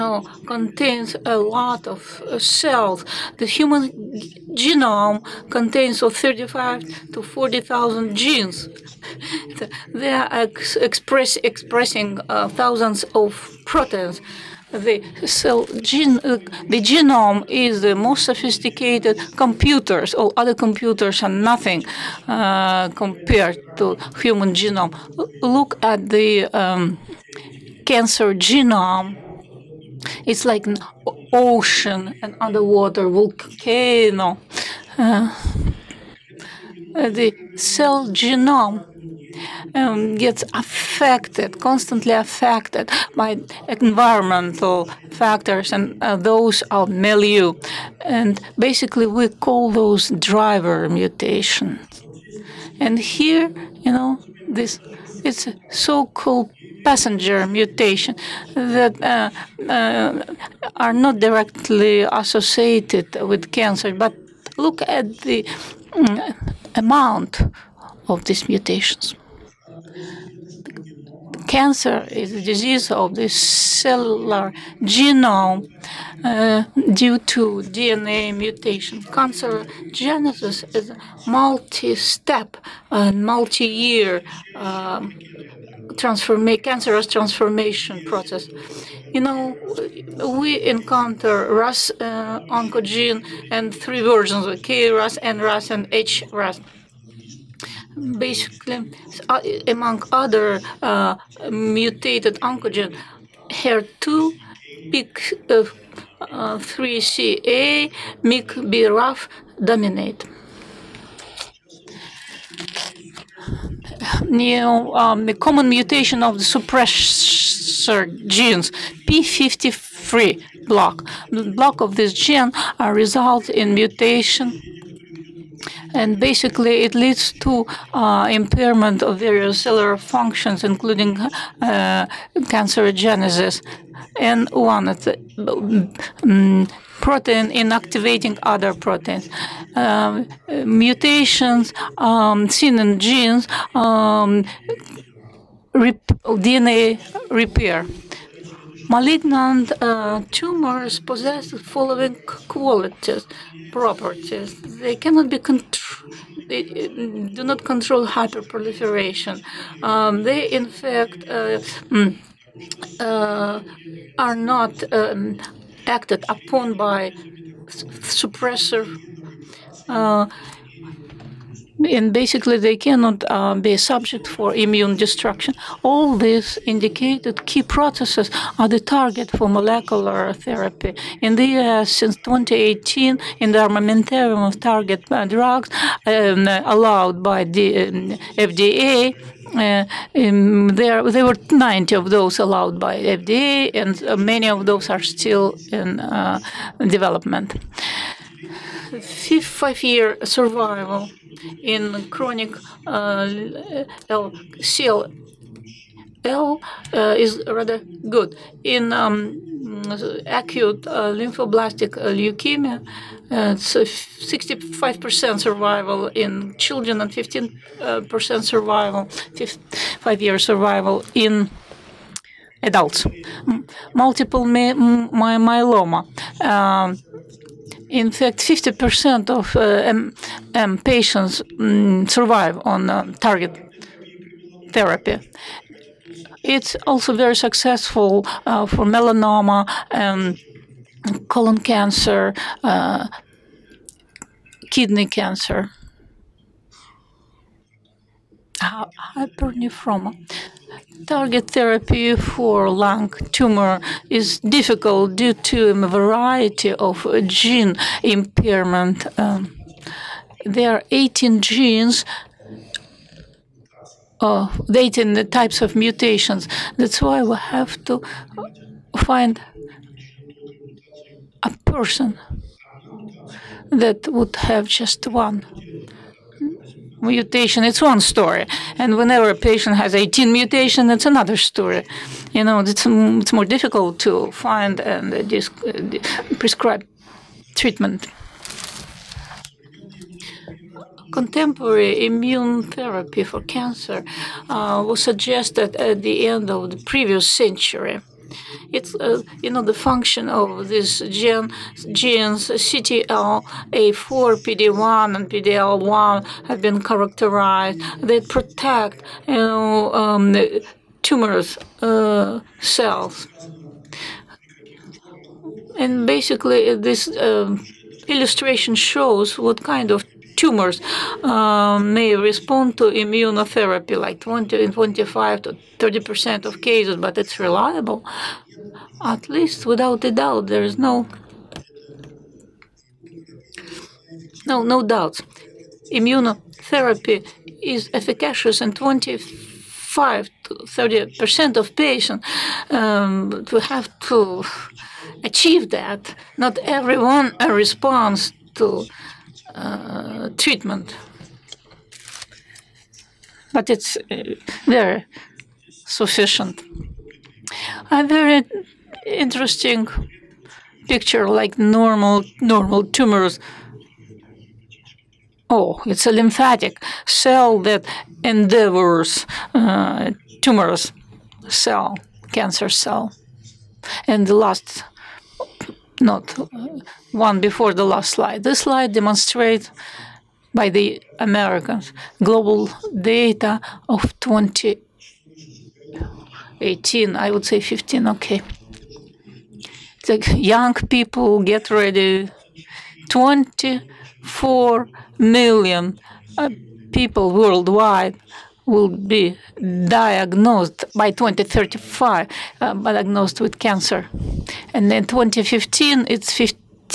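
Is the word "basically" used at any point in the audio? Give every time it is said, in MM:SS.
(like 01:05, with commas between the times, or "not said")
00:48, 01:38, 02:06, 02:52, 05:16.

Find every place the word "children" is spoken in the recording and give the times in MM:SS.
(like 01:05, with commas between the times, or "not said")
03:36.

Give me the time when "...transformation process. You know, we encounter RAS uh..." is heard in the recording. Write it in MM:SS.
01:27.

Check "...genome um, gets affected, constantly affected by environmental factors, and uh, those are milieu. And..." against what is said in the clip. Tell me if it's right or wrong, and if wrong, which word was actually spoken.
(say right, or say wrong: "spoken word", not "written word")
right.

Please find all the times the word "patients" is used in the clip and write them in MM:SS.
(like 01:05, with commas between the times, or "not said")
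03:50, 04:39, 05:41.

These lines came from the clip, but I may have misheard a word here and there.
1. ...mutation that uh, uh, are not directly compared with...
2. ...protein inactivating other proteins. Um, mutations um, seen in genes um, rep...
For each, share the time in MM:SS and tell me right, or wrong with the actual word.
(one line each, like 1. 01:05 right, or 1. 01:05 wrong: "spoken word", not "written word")
1. 00:57 wrong: "associated", not "compared"
2. 02:17 right.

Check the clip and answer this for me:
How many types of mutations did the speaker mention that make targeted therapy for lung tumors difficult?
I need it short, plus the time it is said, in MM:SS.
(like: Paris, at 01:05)
18, at 04:24.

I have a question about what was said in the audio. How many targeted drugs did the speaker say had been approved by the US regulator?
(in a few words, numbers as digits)
90.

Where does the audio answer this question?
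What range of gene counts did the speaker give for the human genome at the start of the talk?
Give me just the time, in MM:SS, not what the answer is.
00:06.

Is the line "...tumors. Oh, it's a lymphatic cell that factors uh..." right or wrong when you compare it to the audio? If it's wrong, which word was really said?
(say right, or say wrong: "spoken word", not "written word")
wrong: "endeavors", not "factors".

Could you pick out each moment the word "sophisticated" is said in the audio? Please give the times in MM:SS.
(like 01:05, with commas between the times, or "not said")
00:18.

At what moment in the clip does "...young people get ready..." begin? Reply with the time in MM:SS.
06:30.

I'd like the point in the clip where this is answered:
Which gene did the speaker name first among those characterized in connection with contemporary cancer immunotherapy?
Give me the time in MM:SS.
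05:02.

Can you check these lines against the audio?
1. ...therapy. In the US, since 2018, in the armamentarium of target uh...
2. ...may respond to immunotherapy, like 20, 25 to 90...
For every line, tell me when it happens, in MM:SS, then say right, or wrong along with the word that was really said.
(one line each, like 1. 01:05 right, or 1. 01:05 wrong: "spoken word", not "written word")
1. 03:00 right
2. 05:21 wrong: "30", not "90".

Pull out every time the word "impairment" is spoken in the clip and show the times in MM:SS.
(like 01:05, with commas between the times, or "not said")
02:08, 04:18.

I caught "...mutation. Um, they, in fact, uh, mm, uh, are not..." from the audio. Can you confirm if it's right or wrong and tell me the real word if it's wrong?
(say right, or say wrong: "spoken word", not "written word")
wrong: "hyperproliferation", not "mutation".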